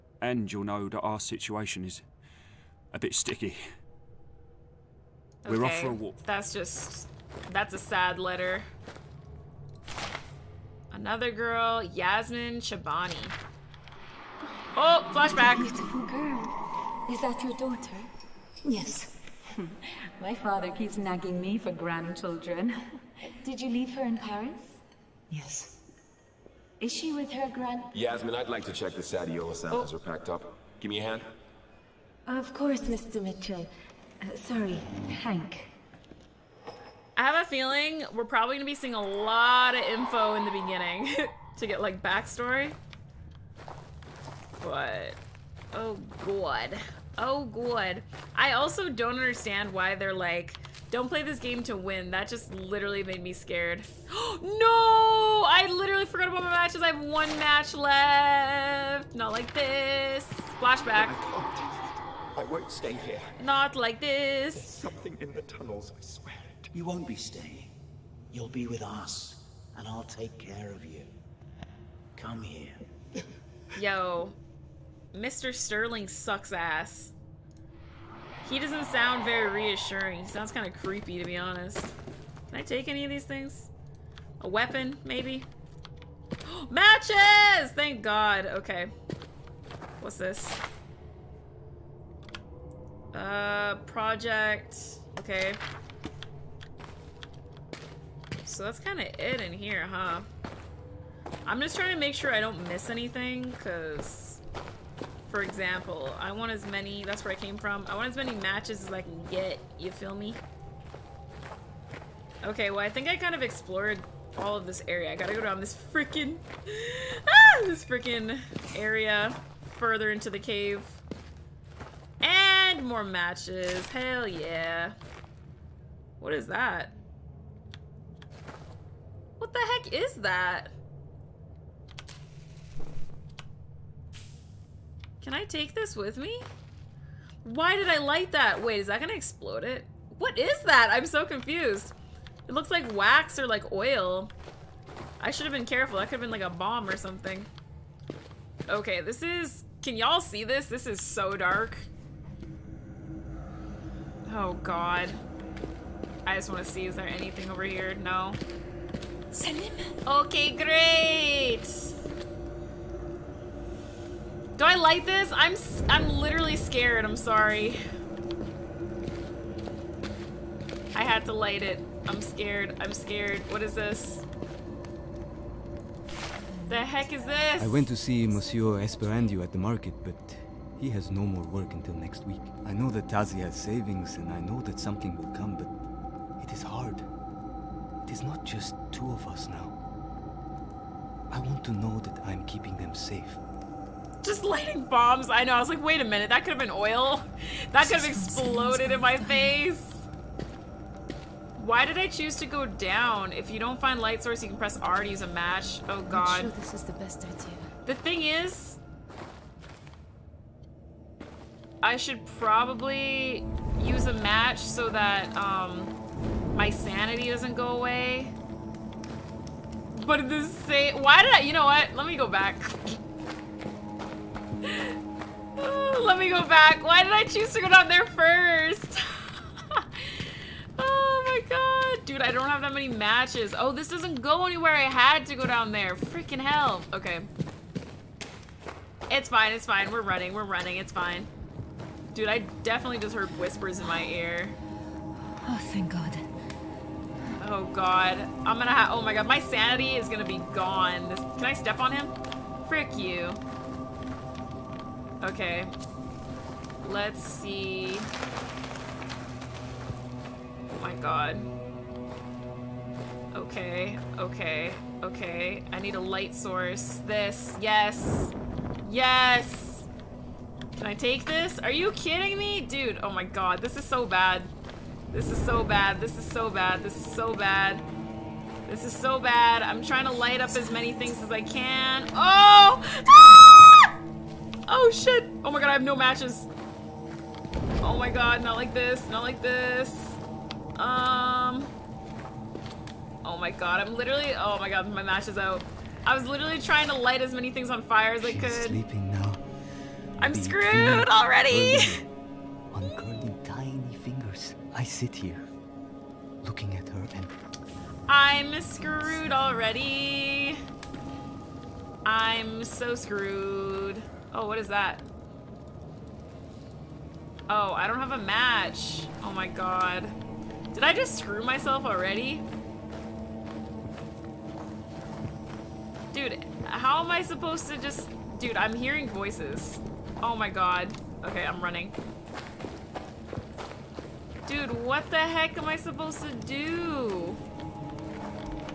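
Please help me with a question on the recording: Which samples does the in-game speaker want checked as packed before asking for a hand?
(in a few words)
Sadiola.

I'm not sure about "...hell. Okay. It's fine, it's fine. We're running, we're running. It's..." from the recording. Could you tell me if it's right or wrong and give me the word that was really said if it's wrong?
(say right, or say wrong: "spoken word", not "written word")
right.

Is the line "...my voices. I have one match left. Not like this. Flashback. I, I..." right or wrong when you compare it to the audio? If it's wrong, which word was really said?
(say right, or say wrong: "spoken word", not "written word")
wrong: "matches", not "voices".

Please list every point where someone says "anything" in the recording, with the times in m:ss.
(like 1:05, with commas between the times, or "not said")
1:42, 2:37.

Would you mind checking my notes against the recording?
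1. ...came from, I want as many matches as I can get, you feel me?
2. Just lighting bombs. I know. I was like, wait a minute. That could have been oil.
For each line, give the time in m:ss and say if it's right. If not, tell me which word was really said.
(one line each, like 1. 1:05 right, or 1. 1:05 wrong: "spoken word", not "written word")
1. 1:47 right
2. 3:14 right.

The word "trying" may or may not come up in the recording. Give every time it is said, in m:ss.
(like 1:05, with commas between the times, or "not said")
1:41, 4:39, 4:56.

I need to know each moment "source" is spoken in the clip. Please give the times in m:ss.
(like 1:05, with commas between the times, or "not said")
3:24, 4:26.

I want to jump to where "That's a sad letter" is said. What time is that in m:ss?
0:07.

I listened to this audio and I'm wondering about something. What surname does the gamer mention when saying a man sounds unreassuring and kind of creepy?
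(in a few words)
Sterling.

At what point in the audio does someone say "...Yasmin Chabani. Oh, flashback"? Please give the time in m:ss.
0:11.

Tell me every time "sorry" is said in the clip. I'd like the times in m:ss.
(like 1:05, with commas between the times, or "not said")
0:34, 2:47.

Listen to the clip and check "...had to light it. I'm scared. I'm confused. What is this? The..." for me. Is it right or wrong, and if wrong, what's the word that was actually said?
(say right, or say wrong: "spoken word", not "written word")
wrong: "scared", not "confused".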